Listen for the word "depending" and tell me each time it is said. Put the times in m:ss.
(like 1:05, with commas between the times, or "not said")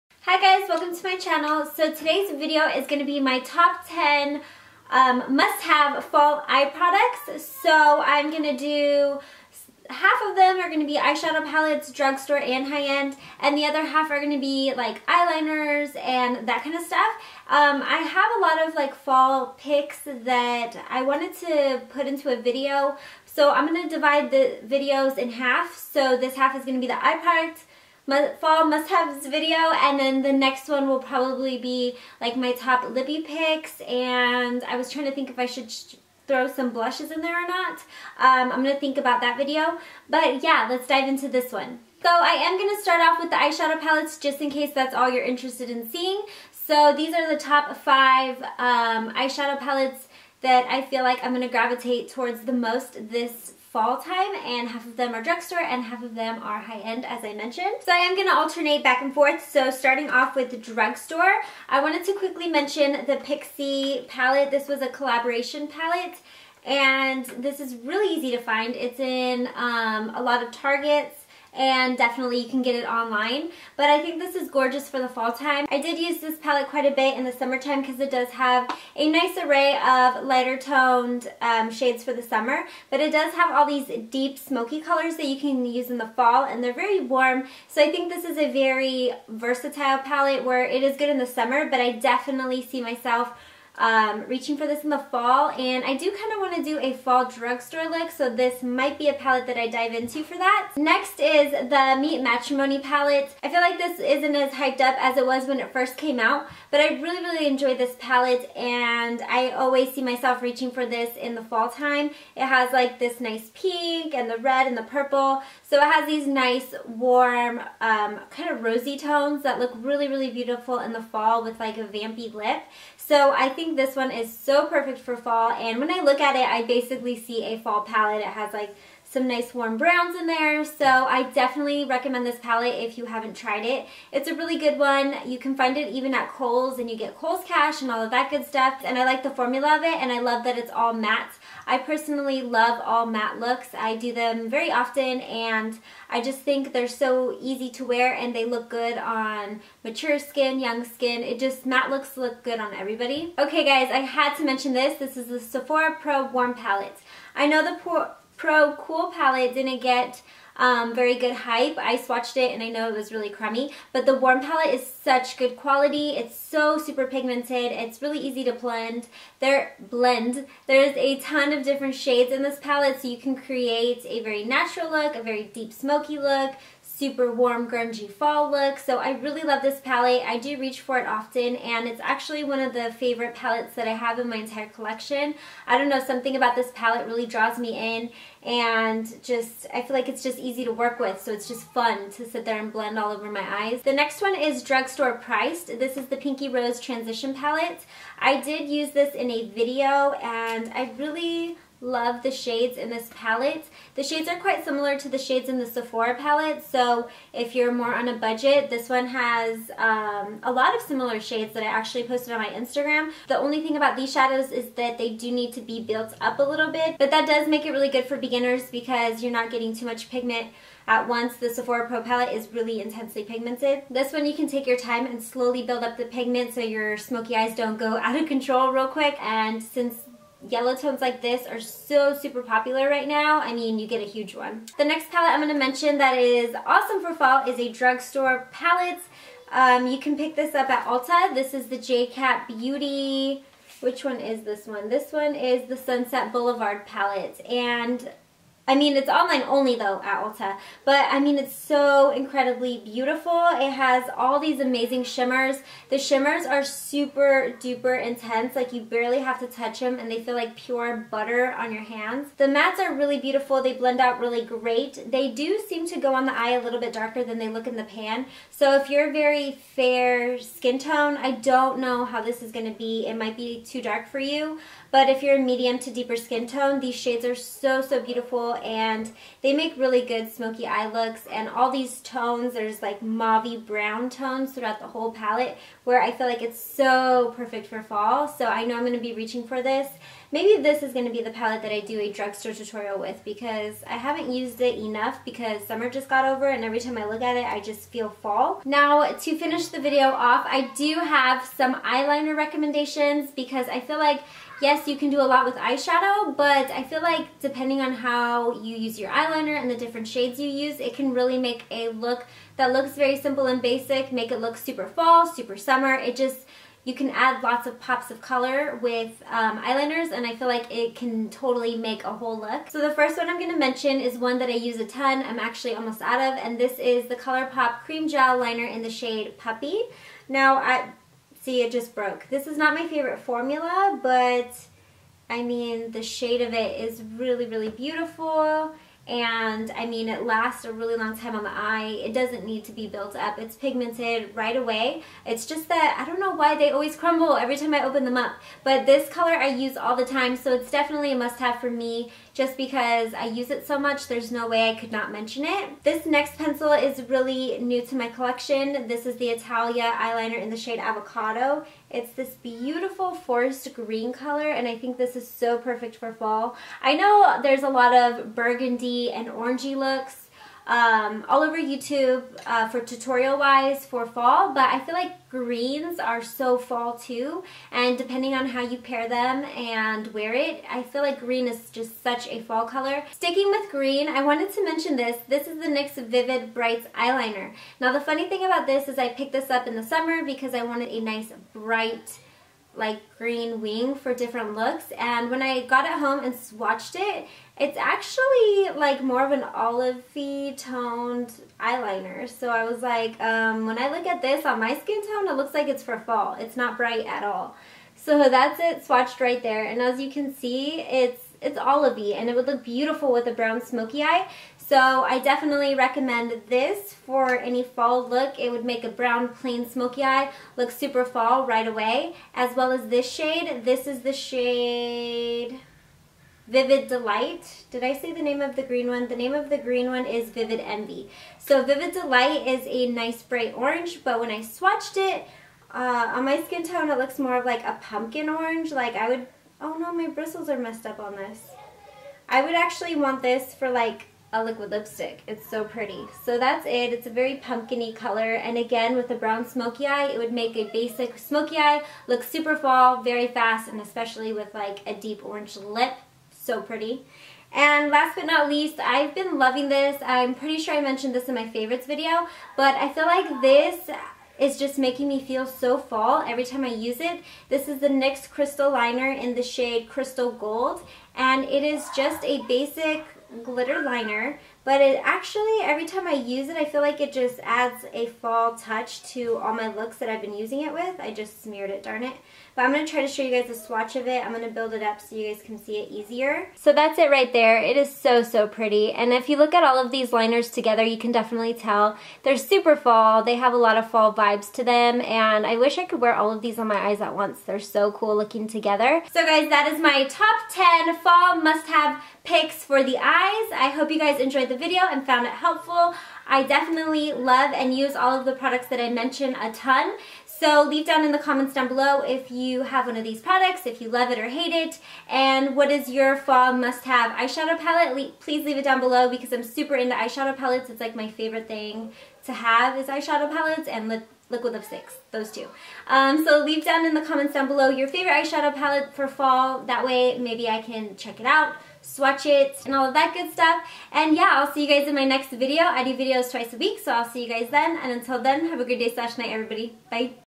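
5:07, 6:17.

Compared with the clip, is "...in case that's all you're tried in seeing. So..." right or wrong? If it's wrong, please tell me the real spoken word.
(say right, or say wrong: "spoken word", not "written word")
wrong: "interested", not "tried".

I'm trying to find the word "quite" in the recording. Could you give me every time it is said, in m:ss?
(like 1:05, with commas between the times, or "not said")
1:16, 3:24.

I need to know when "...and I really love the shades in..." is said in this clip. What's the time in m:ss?
3:20.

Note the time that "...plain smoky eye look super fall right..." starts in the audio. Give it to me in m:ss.
6:59.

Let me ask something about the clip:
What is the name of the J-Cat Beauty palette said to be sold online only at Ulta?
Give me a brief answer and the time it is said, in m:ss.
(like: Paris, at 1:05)
Sunset Boulevard, at 4:05.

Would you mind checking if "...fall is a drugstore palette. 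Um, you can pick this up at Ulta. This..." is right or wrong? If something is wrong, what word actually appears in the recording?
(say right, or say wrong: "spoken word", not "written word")
right.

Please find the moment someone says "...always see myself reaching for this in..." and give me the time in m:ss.
1:49.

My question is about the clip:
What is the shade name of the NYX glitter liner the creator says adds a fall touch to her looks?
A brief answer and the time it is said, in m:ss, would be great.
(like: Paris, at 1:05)
Crystal Gold, at 7:49.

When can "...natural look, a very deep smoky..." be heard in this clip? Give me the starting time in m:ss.
2:54.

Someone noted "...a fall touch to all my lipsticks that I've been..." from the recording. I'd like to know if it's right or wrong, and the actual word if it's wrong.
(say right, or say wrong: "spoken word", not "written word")
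wrong: "looks", not "lipsticks".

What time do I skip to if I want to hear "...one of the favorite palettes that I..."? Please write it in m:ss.
3:02.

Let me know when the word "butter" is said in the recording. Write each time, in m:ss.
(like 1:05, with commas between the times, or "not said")
4:21.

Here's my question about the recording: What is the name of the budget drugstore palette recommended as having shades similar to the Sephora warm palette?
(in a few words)
Pinky Rose Transition Palette.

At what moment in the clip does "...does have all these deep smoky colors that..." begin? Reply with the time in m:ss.
1:23.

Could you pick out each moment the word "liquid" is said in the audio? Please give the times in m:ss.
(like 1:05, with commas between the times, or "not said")
7:24, 8:44.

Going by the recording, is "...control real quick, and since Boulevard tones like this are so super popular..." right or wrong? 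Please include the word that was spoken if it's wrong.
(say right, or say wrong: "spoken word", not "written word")
wrong: "Yellow", not "Boulevard".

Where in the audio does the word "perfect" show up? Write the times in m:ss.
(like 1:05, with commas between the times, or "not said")
2:04, 4:47, 6:05.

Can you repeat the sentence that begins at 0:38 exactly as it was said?
Um, I'm going to think about that video.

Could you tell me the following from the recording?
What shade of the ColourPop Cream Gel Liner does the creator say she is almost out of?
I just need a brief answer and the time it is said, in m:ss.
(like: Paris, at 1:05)
Puppy, at 5:29.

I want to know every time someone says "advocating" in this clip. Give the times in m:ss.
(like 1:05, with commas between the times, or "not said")
not said.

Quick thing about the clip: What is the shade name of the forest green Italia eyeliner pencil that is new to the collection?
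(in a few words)
Avocado.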